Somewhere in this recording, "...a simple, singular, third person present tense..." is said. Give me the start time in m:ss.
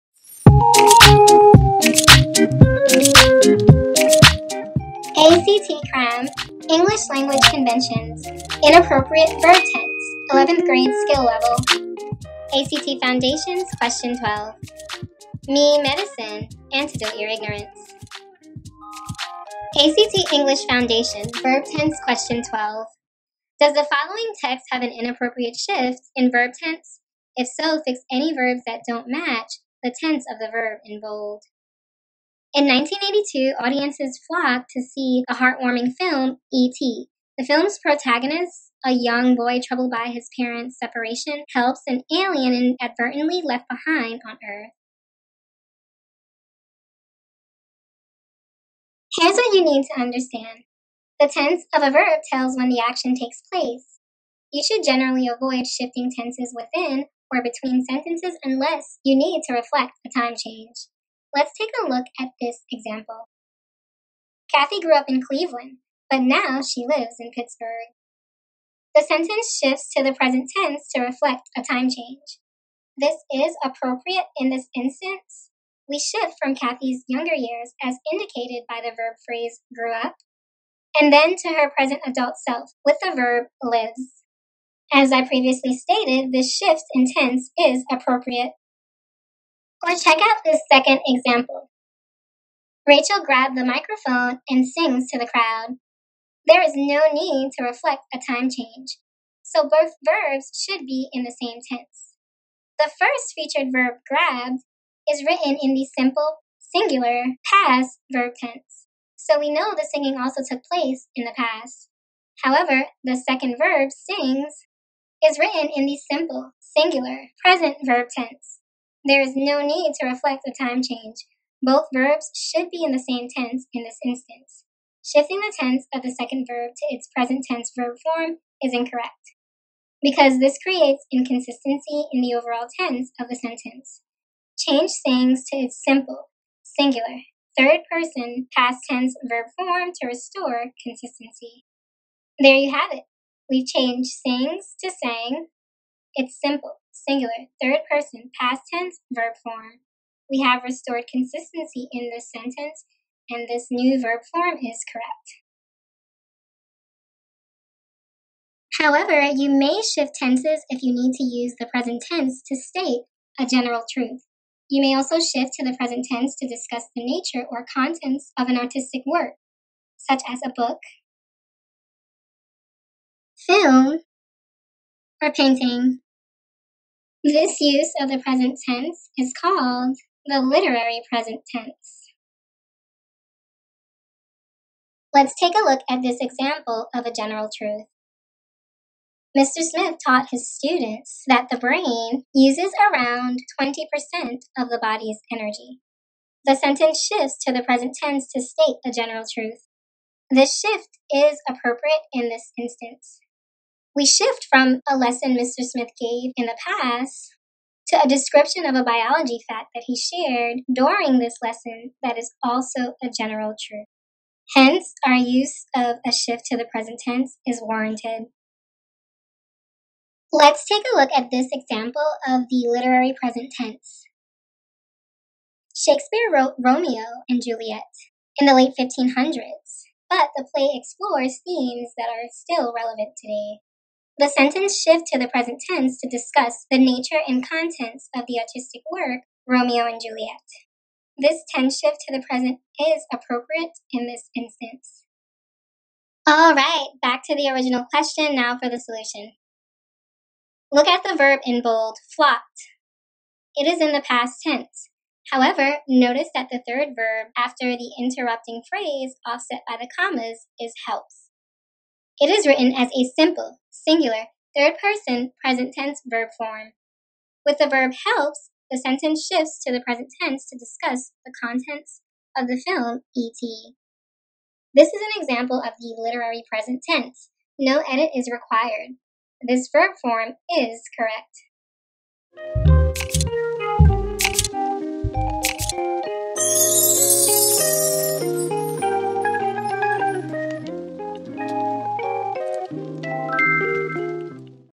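4:22.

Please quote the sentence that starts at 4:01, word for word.
This tense shift to the present is appropriate in this instance.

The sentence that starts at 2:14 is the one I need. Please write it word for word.
Change sings to its simple, singular, third person past tense verb form to restore consistency.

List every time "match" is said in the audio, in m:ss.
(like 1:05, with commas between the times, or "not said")
0:29.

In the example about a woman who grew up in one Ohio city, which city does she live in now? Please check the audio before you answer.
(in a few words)
Pittsburgh.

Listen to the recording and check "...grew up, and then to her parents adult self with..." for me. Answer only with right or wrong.
wrong.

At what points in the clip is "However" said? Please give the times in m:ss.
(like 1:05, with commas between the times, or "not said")
1:52, 2:38, 4:15.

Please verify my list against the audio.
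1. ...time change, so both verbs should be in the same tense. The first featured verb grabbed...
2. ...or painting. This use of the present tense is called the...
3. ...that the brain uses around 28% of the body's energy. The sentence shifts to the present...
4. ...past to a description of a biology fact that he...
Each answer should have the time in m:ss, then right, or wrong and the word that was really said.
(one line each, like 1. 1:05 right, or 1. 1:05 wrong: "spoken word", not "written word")
1. 1:38 right
2. 2:55 right
3. 3:11 wrong: "20", not "28"
4. 3:26 right.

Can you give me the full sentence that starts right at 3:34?
Hence, our use of a shift to the present tense is warranted.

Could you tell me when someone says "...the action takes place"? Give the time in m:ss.
0:52.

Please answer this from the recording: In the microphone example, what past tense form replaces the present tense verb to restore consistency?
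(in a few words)
sang.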